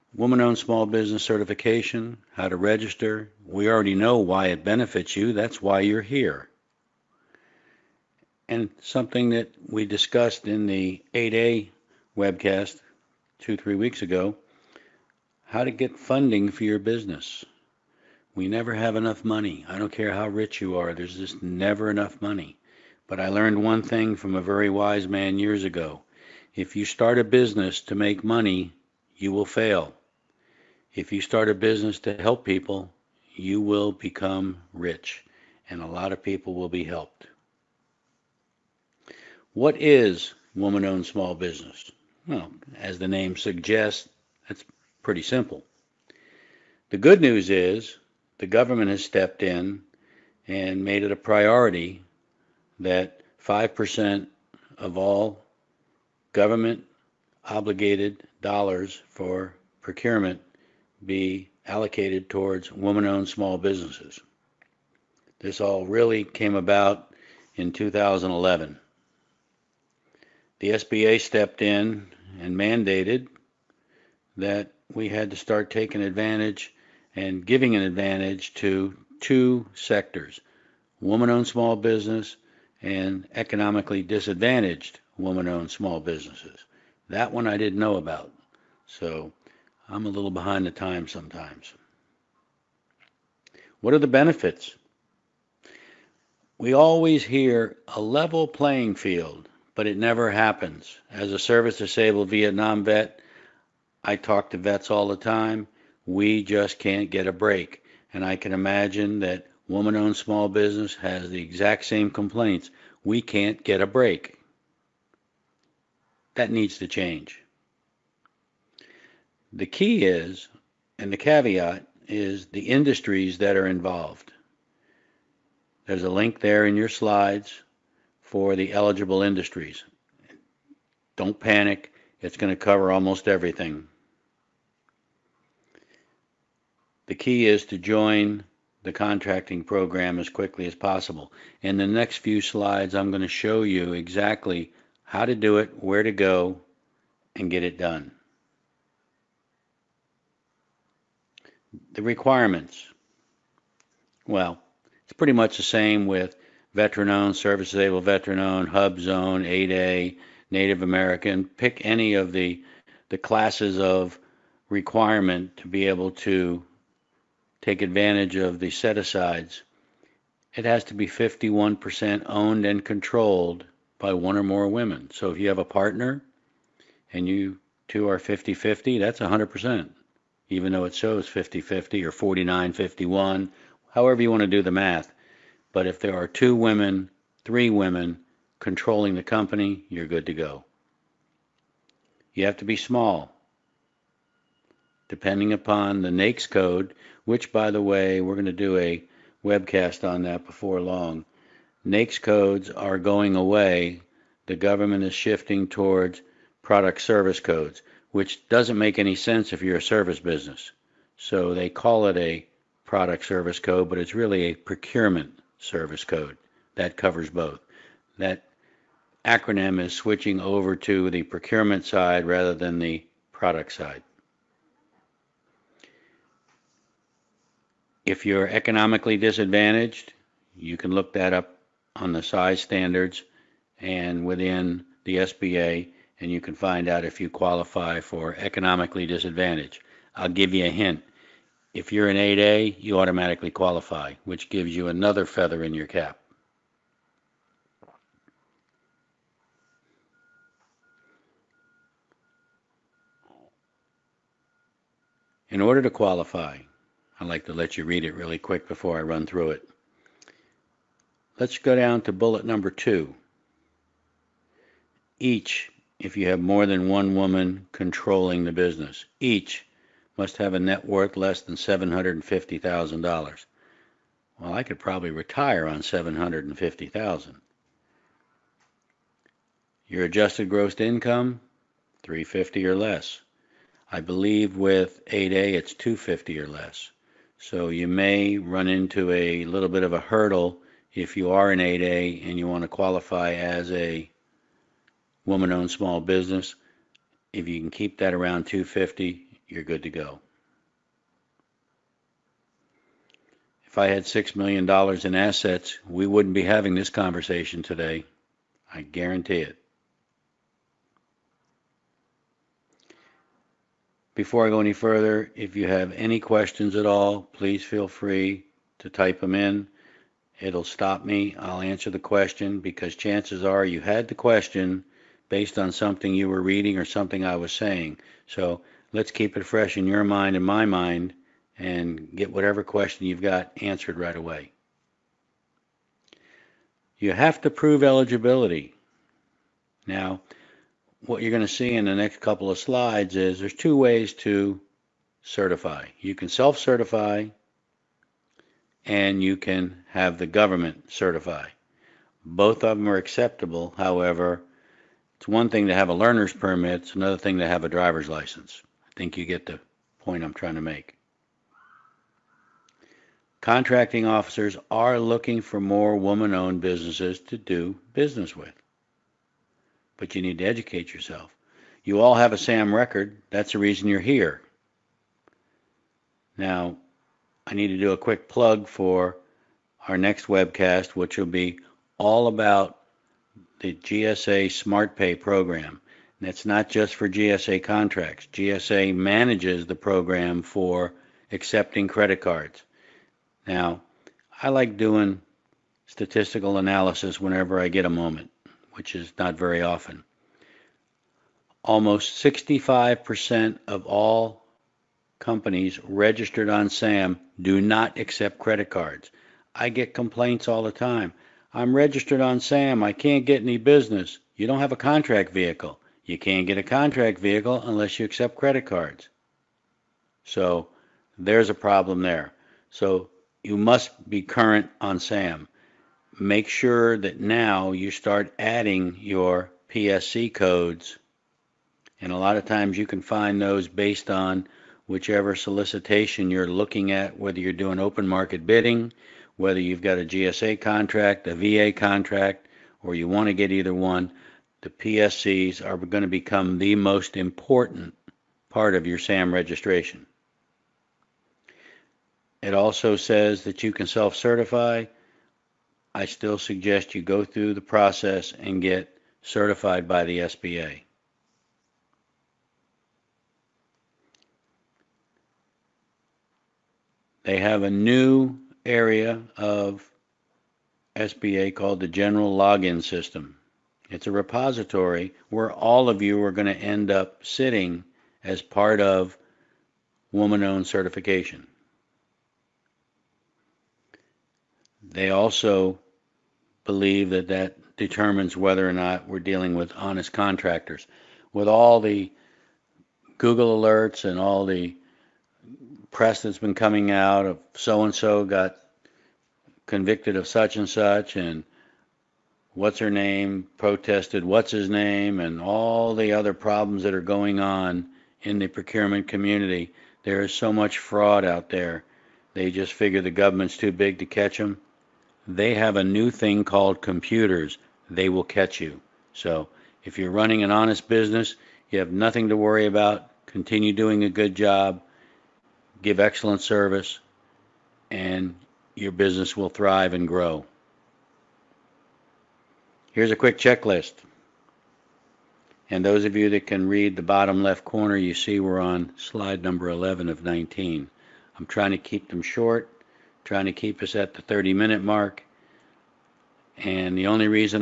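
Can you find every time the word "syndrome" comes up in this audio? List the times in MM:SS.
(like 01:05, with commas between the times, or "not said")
not said.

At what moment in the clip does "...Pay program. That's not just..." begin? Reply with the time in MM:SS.
06:24.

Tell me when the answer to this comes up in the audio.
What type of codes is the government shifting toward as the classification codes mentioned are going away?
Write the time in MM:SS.
03:26.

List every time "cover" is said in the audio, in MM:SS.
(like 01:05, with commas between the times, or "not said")
02:12, 03:36.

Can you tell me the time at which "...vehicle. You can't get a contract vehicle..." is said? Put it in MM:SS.
06:55.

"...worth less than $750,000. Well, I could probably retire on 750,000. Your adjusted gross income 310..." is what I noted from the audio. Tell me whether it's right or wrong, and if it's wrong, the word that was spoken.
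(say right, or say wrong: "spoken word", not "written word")
wrong: "350", not "310".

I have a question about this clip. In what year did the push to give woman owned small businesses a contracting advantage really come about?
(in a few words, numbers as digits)
2011.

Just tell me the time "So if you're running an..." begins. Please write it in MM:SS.
08:39.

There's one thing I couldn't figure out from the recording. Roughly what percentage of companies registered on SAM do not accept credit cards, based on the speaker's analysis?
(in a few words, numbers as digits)
65%.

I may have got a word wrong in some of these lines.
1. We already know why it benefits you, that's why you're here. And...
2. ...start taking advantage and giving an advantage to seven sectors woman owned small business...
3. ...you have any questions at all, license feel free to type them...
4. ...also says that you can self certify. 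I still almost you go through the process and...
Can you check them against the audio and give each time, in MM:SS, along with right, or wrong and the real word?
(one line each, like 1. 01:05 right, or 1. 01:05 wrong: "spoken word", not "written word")
1. 00:03 right
2. 01:15 wrong: "two", not "seven"
3. 05:15 wrong: "please", not "license"
4. 07:32 wrong: "suggest", not "almost".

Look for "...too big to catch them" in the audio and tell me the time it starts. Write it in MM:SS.
08:33.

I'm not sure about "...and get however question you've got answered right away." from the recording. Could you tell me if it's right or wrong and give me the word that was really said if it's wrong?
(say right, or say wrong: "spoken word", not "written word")
wrong: "whatever", not "however".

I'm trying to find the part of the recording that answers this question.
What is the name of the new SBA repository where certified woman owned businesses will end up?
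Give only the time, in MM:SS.
07:51.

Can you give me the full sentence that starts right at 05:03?
If I had $6 million in assets, we wouldn't be having this conversation today.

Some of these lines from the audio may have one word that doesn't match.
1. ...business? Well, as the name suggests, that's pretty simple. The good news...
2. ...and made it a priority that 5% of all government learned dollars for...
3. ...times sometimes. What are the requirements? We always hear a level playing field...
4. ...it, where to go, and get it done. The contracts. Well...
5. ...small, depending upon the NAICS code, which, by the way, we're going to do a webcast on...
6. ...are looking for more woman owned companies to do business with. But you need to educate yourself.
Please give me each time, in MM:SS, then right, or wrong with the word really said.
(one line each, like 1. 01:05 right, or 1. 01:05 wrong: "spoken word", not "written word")
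1. 00:41 right
2. 00:50 wrong: "obligated", not "learned"
3. 01:30 wrong: "benefits", not "requirements"
4. 02:25 wrong: "requirements", not "contracts"
5. 03:12 right
6. 06:04 wrong: "businesses", not "companies".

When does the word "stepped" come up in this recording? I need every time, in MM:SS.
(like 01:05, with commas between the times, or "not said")
00:49, 01:11.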